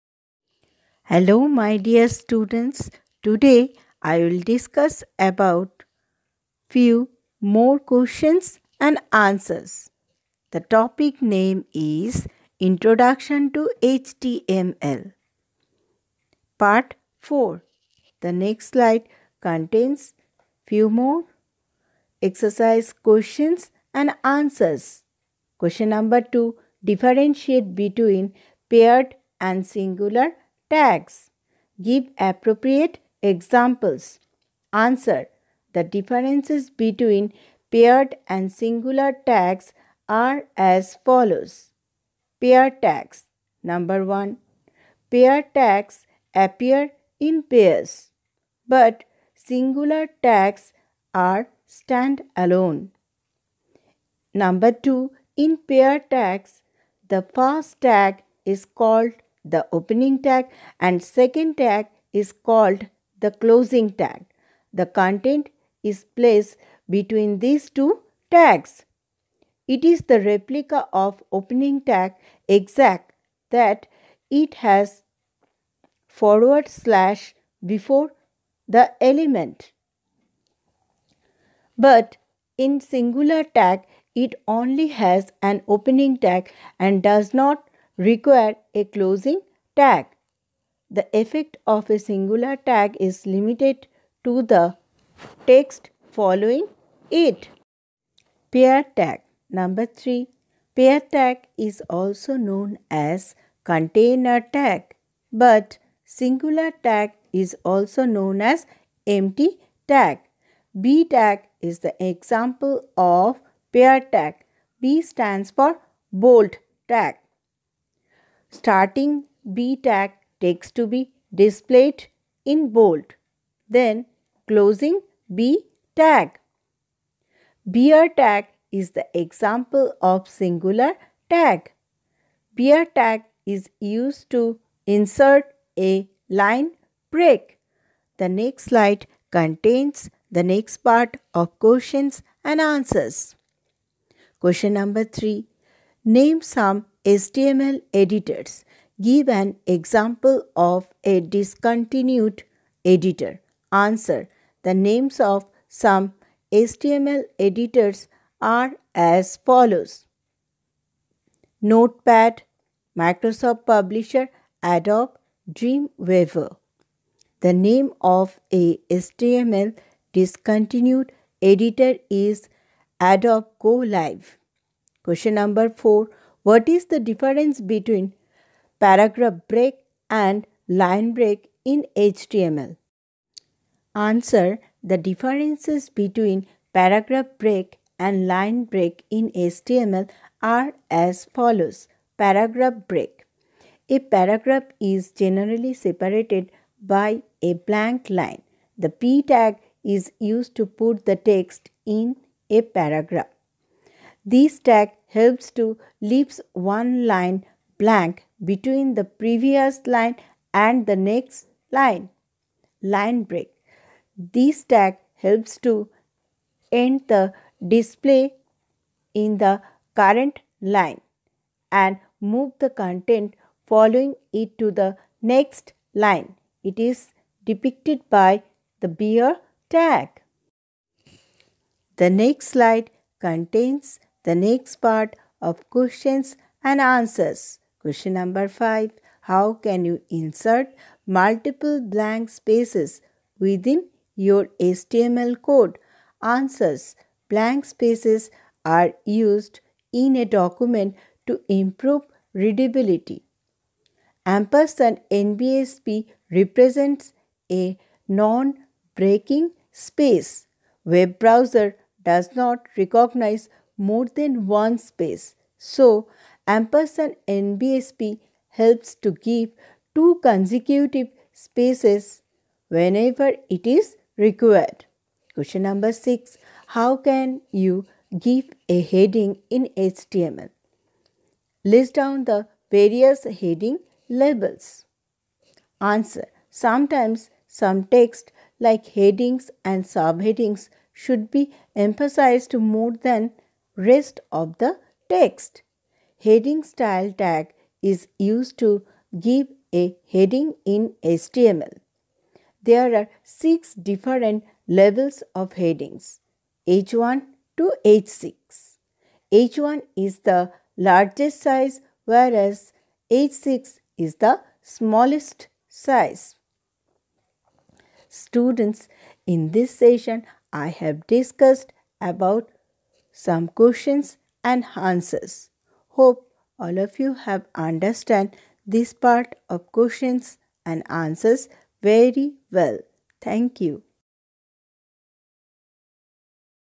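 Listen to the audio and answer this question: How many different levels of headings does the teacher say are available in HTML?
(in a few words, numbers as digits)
6.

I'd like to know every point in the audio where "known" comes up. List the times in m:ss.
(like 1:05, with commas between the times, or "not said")
1:42, 1:48.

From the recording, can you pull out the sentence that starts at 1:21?
But in singular tag, it only has an opening tag and does not require a closing tag.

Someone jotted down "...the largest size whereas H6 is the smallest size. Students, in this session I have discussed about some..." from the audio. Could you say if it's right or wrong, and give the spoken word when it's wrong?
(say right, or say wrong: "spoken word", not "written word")
right.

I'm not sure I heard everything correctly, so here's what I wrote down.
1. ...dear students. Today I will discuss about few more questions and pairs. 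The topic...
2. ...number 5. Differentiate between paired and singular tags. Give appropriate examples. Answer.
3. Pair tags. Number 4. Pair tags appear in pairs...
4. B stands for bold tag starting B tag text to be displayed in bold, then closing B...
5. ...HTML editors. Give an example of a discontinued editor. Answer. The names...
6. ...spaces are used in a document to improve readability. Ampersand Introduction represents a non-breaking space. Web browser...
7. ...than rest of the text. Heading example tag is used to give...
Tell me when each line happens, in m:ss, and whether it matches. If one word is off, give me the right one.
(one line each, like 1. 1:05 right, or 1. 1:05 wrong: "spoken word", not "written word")
1. 0:01 wrong: "answers", not "pairs"
2. 0:25 wrong: "2", not "5"
3. 0:42 wrong: "1", not "4"
4. 1:54 right
5. 2:27 right
6. 4:07 wrong: "NBSP", not "Introduction"
7. 4:52 wrong: "style", not "example".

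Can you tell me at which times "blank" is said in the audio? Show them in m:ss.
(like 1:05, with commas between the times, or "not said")
3:17, 3:27, 4:01, 4:07.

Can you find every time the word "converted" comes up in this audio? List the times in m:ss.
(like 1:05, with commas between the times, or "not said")
not said.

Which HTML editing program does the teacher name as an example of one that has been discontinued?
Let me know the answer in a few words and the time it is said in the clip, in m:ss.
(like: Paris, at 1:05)
Adobe GoLive, at 2:52.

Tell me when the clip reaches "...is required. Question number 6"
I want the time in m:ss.
4:33.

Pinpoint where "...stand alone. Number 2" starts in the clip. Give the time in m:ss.
0:51.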